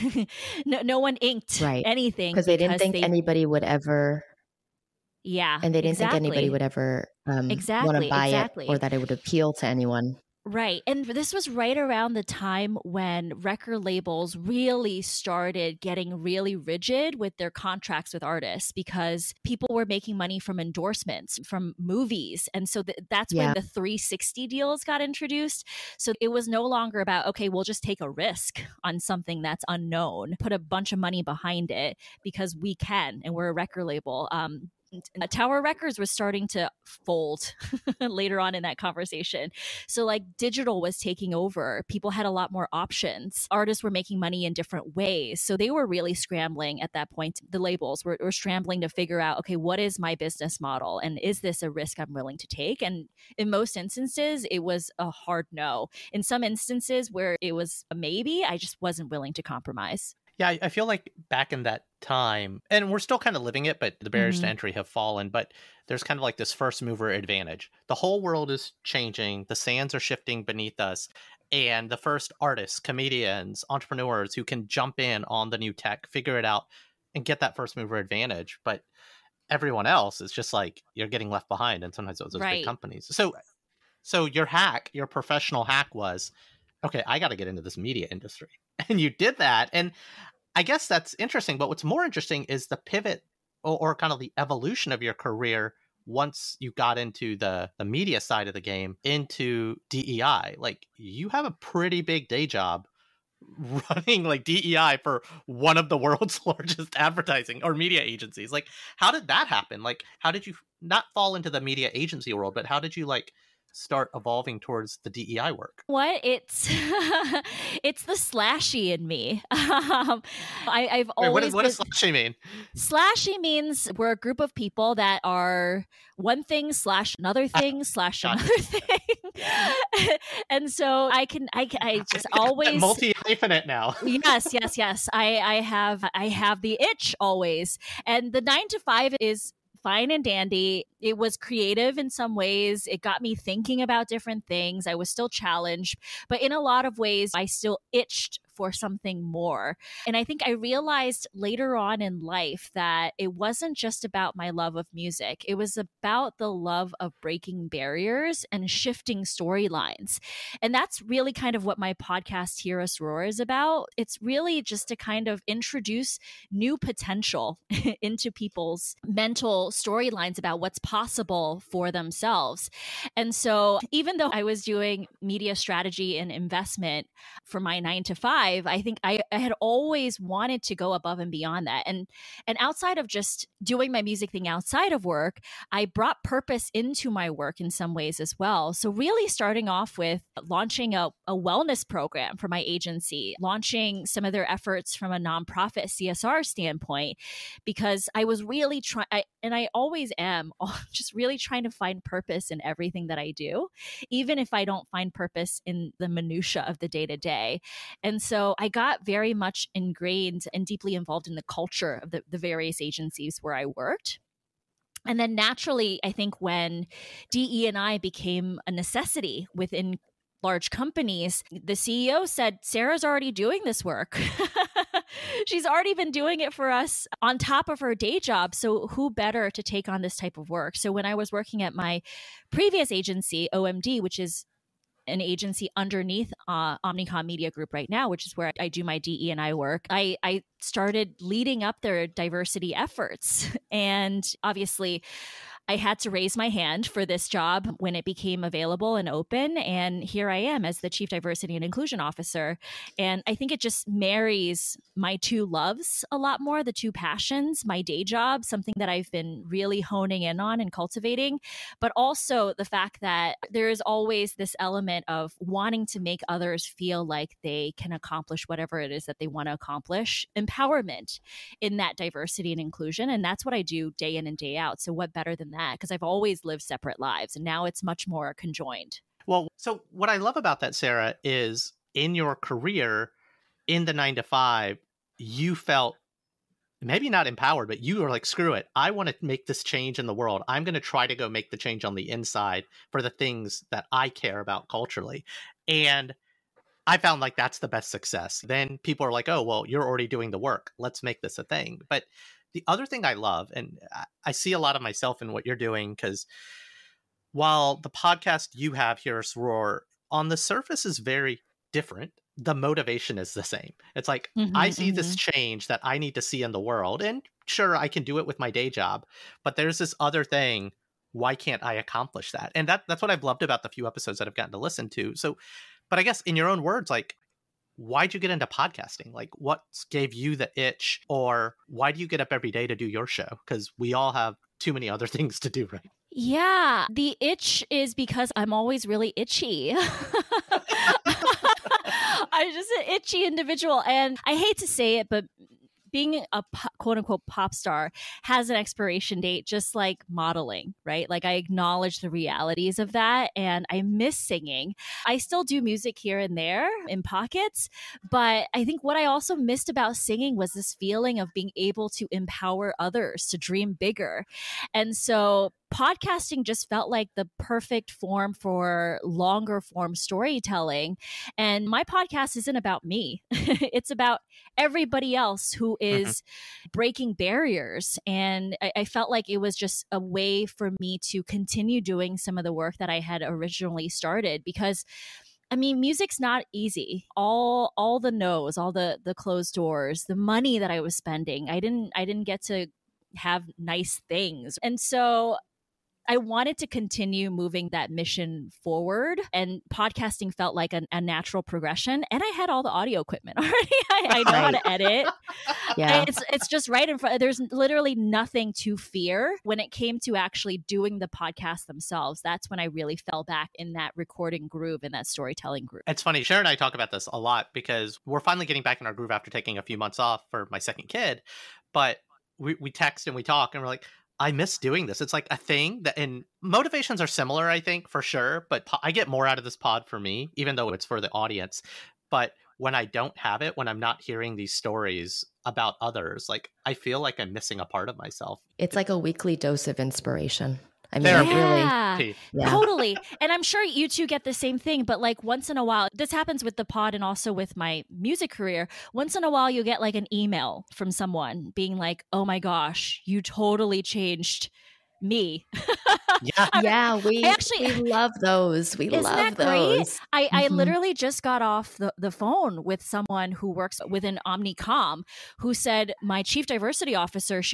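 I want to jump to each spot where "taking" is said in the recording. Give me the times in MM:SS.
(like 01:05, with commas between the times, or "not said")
00:40, 06:59.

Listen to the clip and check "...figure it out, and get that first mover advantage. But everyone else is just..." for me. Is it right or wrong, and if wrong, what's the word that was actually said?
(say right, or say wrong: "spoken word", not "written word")
right.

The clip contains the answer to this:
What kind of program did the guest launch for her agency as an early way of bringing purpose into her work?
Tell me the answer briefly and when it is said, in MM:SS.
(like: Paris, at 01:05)
wellness program, at 03:11.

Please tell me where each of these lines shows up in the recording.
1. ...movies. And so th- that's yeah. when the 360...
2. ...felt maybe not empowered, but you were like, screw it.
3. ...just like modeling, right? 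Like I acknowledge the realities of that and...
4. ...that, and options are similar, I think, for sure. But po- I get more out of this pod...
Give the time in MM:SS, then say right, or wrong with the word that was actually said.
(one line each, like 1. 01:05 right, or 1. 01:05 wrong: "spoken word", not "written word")
1. 00:21 right
2. 04:45 right
3. 05:49 right
4. 07:05 wrong: "motivations", not "options".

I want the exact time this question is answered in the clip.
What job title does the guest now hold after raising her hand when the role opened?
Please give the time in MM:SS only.
04:10.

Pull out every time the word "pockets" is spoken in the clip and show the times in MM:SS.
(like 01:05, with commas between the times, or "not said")
05:57.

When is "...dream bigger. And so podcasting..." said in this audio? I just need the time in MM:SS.
06:03.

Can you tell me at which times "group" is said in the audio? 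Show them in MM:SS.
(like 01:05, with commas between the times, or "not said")
02:04, 03:57.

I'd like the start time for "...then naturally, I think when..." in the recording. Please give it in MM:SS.
03:35.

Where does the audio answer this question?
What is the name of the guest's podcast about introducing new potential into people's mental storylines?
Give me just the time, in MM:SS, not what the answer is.
02:42.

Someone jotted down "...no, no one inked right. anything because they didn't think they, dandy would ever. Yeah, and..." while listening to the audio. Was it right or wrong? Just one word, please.
wrong.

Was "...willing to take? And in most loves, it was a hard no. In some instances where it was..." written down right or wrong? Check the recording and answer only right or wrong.
wrong.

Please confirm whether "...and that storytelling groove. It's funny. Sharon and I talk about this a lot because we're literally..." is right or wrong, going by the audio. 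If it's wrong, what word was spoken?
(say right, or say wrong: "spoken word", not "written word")
wrong: "finally", not "literally".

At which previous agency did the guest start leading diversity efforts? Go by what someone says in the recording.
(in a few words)
OMD.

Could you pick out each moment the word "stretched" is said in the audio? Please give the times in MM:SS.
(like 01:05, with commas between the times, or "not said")
not said.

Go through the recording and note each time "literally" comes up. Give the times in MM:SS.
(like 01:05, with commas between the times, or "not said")
06:47, 07:40.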